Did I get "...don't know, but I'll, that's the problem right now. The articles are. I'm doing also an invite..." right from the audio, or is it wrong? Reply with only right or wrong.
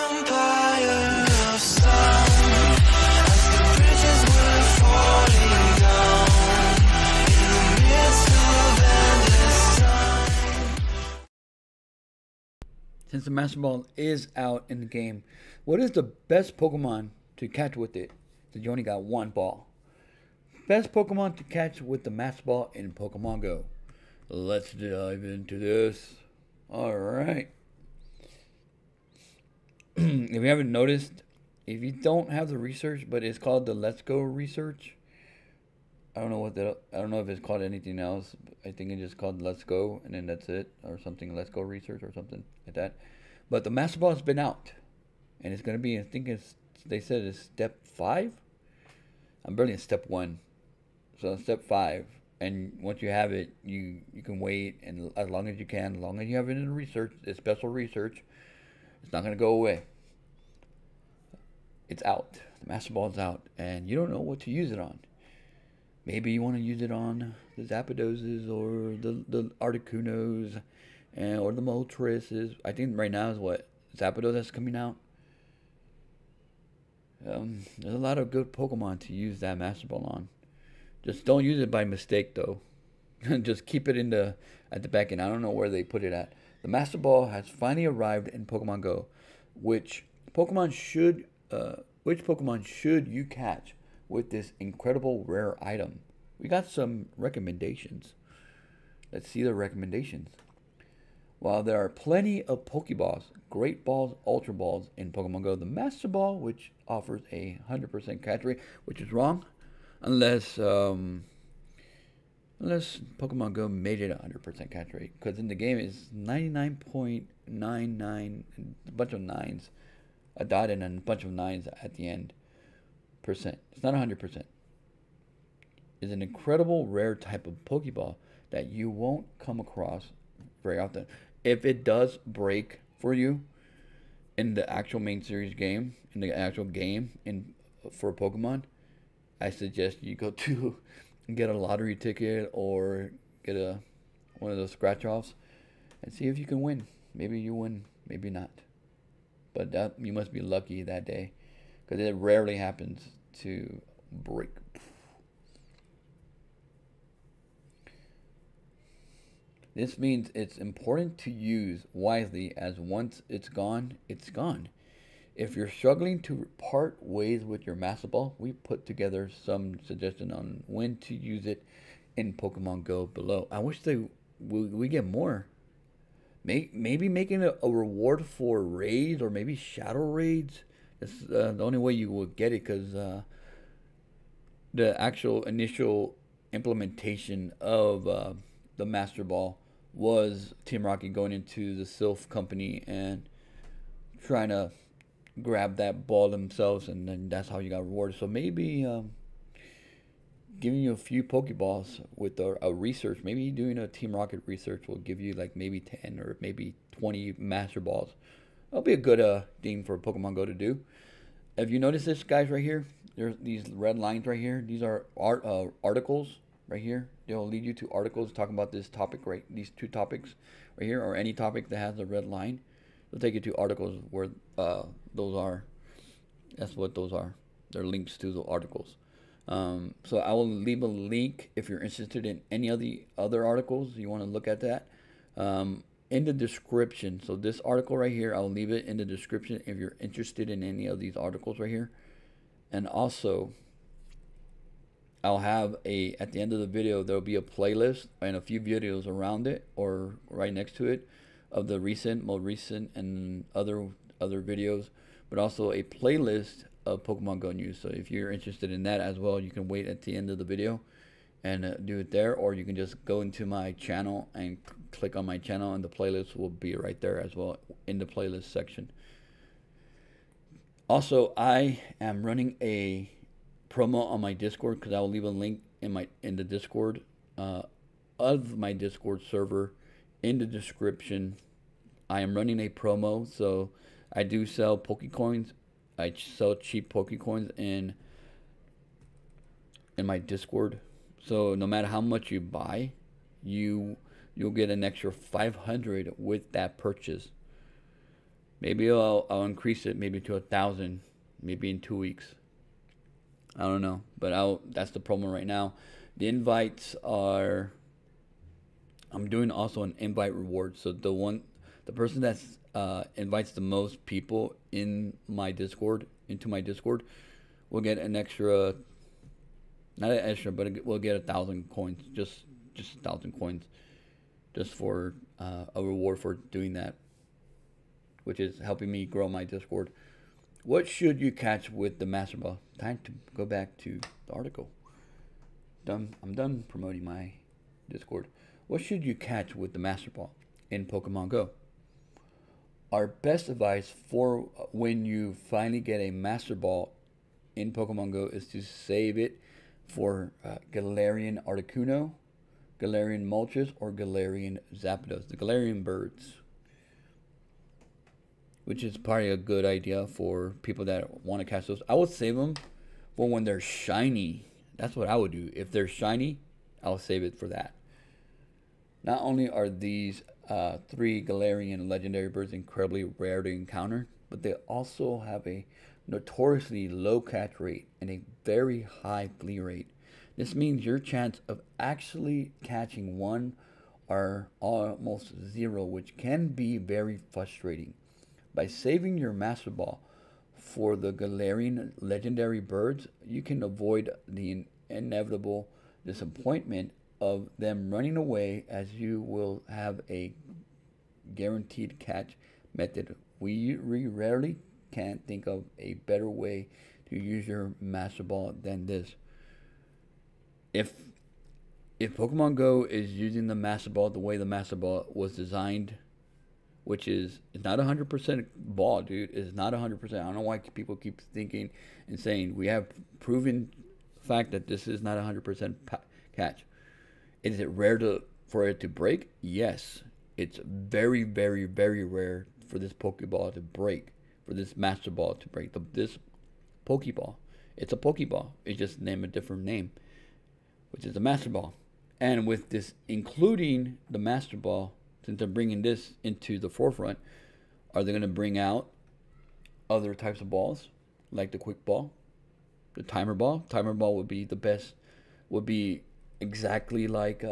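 wrong.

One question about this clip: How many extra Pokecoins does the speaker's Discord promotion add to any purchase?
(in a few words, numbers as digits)
500.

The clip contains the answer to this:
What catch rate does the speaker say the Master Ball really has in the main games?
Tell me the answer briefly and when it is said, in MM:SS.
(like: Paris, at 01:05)
99.99, at 01:56.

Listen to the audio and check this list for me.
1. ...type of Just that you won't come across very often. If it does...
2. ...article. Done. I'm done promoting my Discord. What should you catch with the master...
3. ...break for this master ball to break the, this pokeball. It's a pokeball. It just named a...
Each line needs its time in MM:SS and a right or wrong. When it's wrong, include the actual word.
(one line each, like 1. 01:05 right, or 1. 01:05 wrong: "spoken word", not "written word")
1. 02:07 wrong: "Pokeball", not "Just"
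2. 05:34 right
3. 07:13 right.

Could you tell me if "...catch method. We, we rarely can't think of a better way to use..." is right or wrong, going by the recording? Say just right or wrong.
right.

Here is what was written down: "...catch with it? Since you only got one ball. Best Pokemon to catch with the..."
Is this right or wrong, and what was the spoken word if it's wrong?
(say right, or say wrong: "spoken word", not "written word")
right.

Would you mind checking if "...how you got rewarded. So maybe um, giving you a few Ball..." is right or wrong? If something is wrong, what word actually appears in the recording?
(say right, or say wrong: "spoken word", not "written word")
wrong: "Pokeballs", not "Ball".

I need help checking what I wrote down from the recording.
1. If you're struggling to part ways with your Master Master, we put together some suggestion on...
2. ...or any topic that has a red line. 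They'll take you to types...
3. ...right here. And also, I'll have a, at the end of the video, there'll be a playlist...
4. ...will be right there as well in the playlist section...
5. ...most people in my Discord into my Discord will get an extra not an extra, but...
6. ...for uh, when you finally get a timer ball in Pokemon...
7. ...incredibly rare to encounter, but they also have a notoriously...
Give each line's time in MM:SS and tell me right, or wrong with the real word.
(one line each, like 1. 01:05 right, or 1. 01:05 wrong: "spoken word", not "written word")
1. 02:45 wrong: "Ball", not "Master"
2. 03:41 wrong: "articles", not "types"
3. 04:01 right
4. 04:26 right
5. 05:13 right
6. 05:44 wrong: "master", not "timer"
7. 06:12 right.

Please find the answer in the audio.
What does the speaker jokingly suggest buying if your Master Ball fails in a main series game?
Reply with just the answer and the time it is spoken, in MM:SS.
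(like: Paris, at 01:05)
A lottery ticket, at 02:21.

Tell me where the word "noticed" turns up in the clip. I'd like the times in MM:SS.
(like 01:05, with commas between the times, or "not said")
00:30, 03:31.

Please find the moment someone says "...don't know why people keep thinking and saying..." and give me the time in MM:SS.
07:00.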